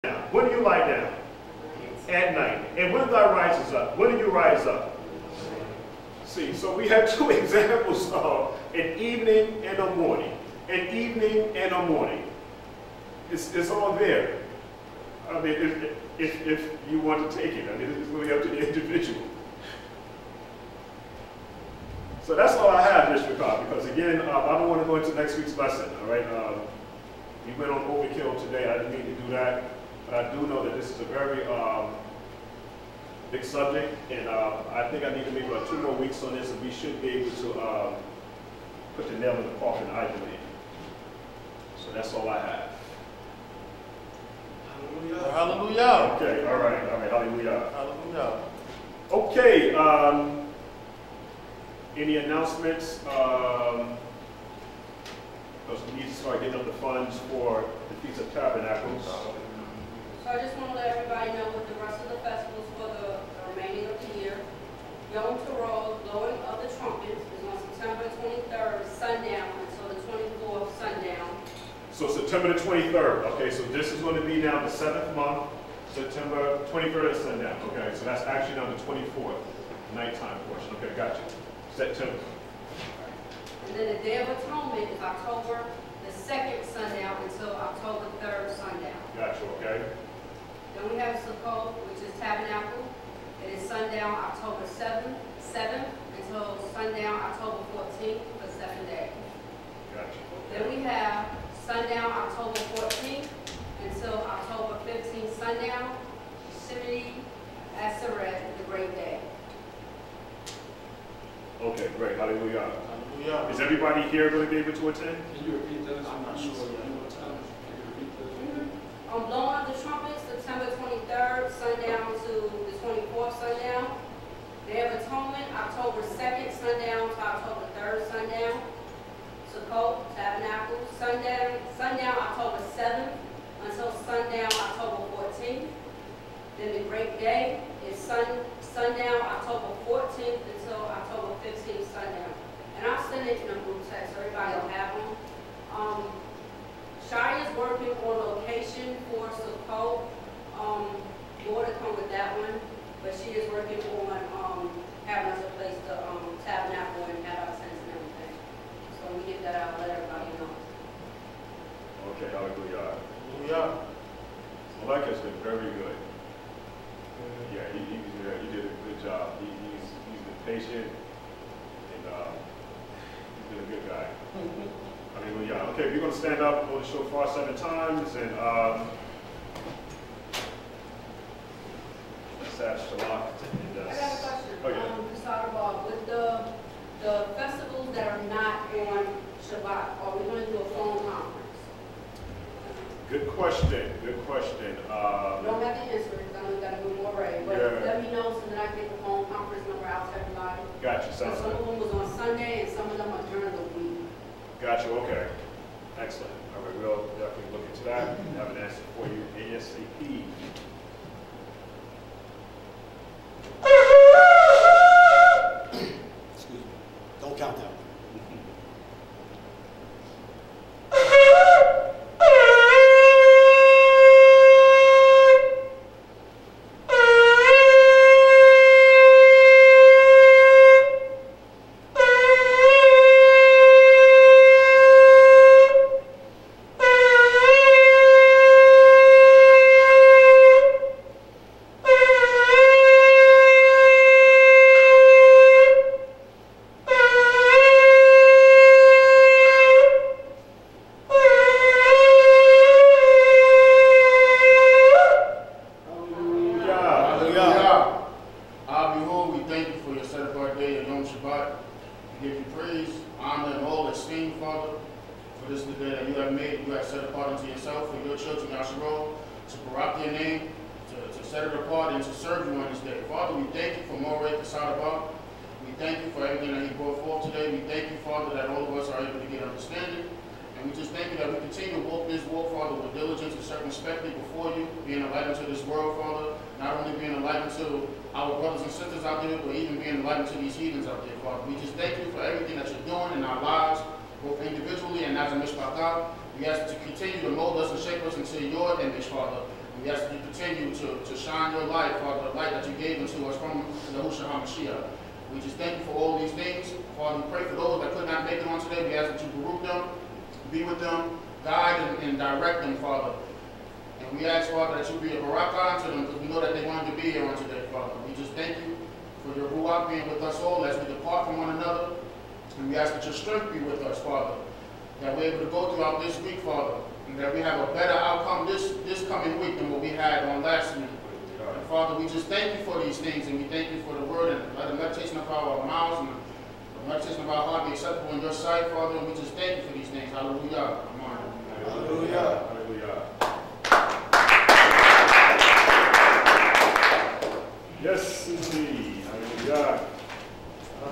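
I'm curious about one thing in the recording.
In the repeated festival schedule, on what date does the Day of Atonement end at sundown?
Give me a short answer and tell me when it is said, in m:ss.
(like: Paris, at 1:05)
October 3rd, at 2:07.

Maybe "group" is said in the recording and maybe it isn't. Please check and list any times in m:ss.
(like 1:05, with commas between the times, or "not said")
2:23, 5:09.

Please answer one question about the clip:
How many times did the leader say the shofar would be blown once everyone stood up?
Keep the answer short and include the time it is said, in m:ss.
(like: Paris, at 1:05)
7 times, at 2:57.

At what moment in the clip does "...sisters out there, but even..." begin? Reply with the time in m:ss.
4:48.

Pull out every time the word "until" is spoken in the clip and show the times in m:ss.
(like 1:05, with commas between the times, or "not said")
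1:09, 1:27, 1:36, 1:43, 2:13, 2:20.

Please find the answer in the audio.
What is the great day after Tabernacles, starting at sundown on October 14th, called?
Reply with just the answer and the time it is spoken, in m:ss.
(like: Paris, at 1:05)
Shimini Aseret, at 1:46.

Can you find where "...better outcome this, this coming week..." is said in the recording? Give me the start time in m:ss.
5:27.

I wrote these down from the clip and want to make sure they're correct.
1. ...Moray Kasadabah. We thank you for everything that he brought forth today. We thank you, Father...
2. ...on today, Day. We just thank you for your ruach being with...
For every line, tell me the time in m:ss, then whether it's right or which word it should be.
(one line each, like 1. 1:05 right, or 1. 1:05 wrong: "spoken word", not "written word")
1. 4:33 right
2. 5:17 wrong: "Father", not "Day".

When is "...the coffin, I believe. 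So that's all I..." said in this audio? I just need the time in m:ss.
0:39.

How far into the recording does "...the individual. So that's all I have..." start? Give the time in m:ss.
0:18.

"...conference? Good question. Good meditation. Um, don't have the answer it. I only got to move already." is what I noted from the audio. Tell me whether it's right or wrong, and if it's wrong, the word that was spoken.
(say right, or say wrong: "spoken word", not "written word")
wrong: "question", not "meditation".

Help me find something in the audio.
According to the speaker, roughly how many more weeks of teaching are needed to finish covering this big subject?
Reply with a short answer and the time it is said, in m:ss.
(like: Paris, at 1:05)
2 more weeks, at 0:35.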